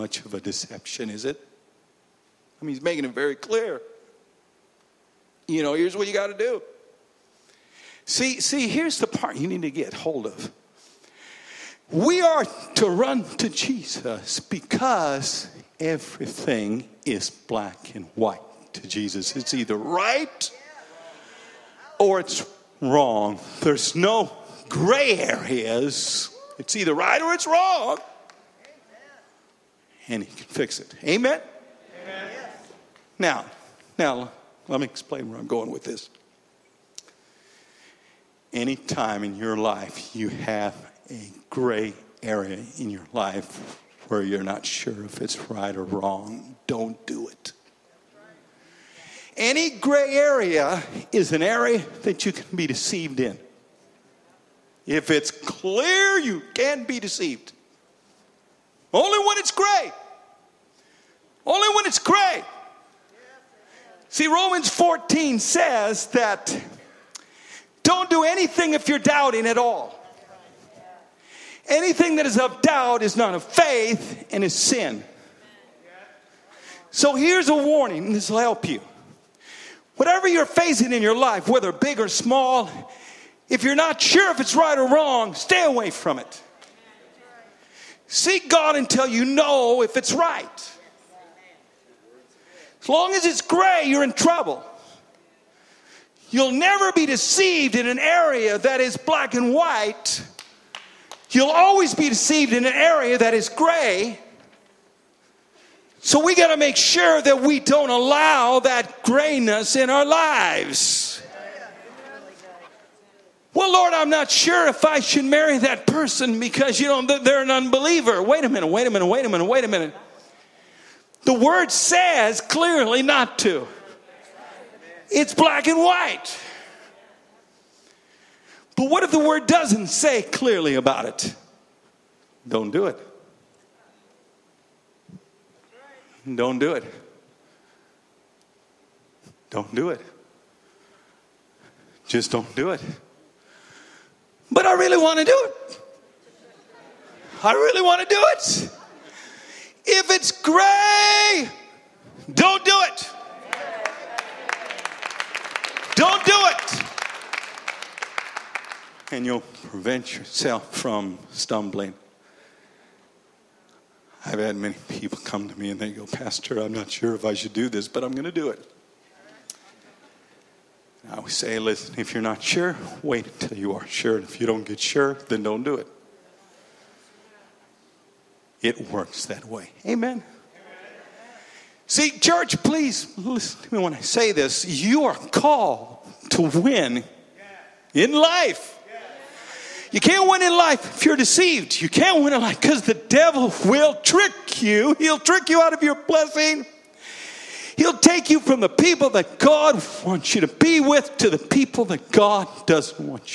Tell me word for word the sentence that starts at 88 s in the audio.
Seek God until you know if it's right.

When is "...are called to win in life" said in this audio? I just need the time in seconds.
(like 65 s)
185 s.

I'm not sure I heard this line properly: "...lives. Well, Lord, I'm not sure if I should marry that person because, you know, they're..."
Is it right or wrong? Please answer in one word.
right.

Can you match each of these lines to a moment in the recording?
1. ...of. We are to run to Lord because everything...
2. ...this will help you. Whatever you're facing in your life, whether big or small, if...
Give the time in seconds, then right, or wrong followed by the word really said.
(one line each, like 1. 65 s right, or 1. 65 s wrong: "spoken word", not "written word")
1. 10 s wrong: "Jesus", not "Lord"
2. 78 s right.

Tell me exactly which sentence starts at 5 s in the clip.
You know, here's what you got to do.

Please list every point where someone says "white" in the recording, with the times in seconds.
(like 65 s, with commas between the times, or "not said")
18 s, 99 s, 125 s.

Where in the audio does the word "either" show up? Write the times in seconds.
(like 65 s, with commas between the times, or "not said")
19 s, 26 s.